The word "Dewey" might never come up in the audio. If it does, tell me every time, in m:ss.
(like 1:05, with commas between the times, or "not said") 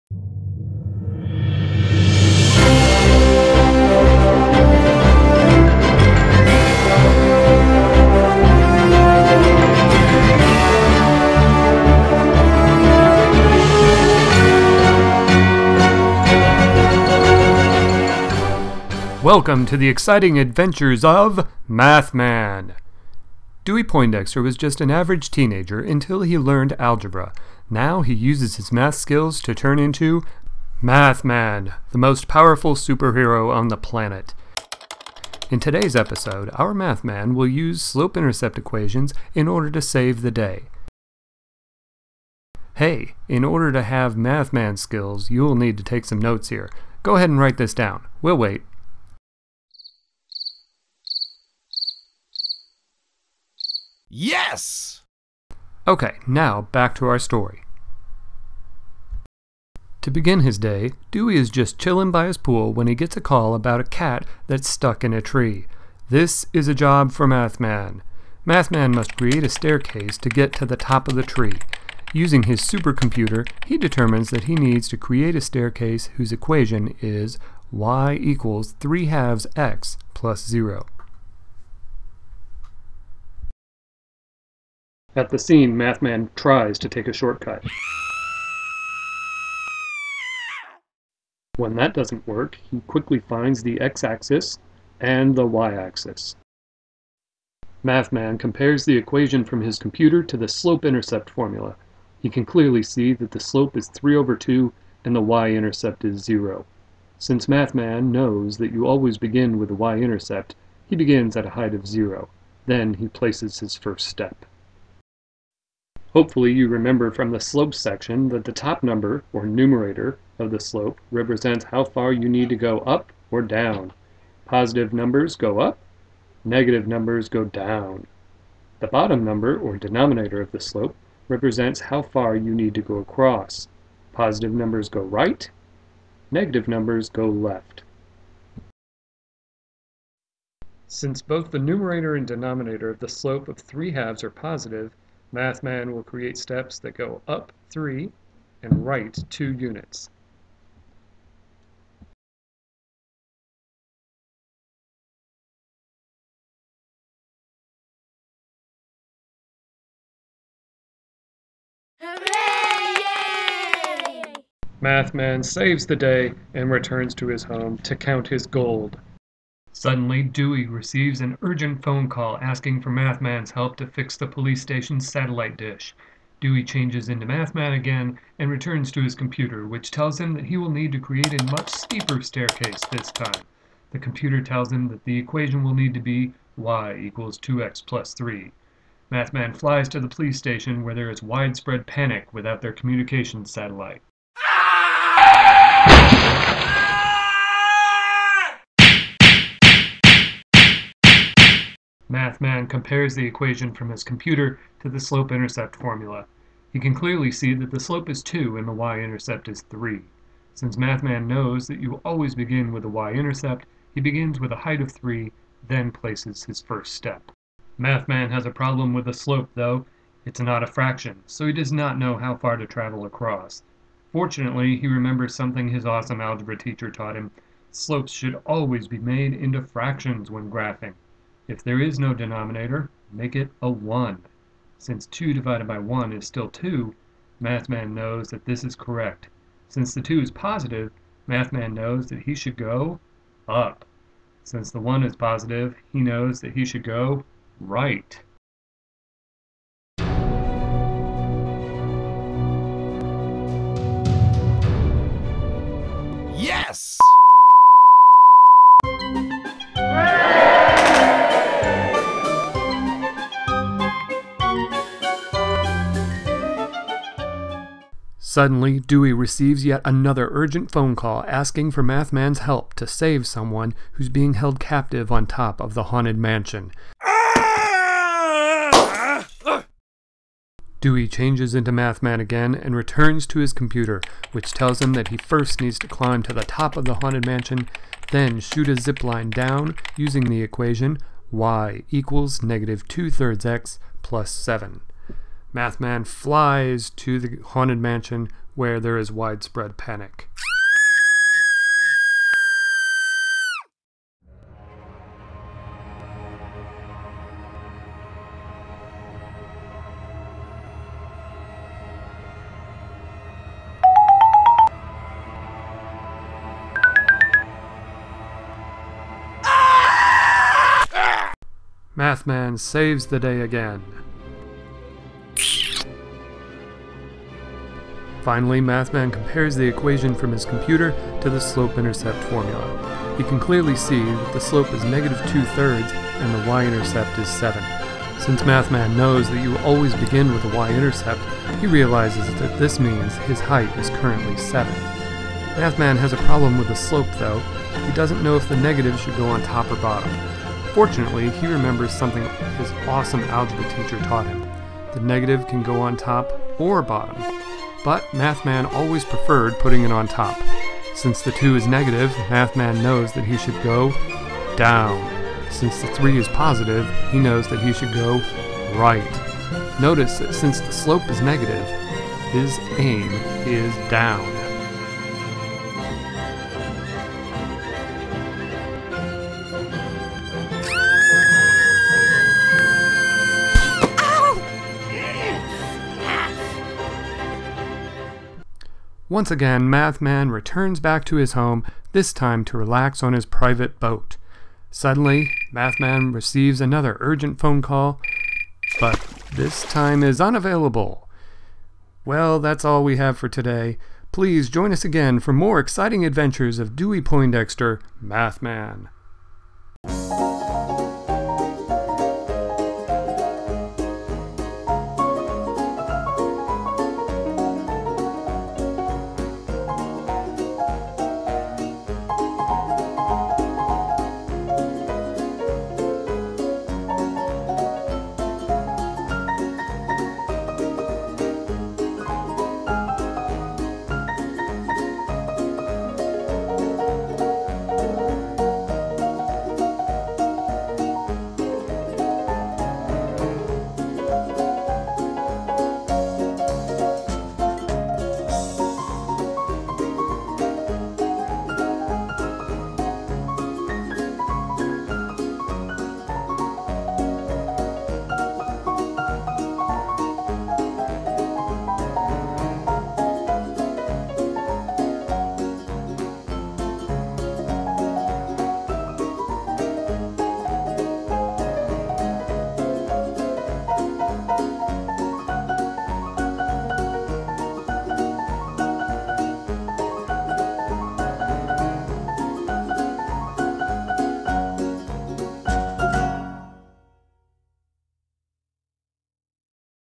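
0:23, 1:01, 2:50, 2:56, 4:28, 4:40, 6:46.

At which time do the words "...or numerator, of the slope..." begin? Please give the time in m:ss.
1:59.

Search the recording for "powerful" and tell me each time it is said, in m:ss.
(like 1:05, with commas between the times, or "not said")
0:32.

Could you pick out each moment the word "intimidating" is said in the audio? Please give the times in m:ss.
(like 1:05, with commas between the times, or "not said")
not said.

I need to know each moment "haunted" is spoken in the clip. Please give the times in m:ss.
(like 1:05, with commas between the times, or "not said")
4:35, 4:46, 4:57.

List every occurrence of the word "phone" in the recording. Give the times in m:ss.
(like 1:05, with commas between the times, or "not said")
2:51, 4:30, 6:37.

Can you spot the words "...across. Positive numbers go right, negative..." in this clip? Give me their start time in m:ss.
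2:12.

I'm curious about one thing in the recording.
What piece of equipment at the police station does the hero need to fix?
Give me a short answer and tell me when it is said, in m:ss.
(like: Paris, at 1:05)
satellite dish, at 2:55.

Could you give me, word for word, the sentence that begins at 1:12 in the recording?
Using his supercomputer, he determines that he needs to create a staircase whose equation is y equals 3 halves x plus 0.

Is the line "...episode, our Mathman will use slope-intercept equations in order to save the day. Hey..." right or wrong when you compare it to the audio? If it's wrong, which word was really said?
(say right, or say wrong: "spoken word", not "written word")
right.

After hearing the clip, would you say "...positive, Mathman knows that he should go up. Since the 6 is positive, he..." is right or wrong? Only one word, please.
wrong.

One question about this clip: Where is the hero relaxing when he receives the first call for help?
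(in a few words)
by his pool.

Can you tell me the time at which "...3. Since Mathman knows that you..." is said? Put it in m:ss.
3:29.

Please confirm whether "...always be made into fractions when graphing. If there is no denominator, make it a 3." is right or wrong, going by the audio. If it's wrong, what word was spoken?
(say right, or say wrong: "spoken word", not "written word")
wrong: "1", not "3".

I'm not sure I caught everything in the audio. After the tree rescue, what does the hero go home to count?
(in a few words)
his gold.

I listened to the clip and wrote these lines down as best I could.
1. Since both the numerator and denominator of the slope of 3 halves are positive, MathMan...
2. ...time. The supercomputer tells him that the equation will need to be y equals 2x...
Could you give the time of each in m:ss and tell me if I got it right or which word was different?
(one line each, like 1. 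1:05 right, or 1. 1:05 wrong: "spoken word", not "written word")
1. 2:20 right
2. 3:03 wrong: "computer", not "supercomputer".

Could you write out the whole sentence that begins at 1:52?
Then he places his first step.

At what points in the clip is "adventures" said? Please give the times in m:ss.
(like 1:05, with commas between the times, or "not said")
0:20, 6:46.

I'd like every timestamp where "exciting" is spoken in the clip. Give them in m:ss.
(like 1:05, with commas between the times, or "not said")
0:19, 6:45.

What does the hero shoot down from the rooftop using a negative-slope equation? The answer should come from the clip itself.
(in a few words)
zipline.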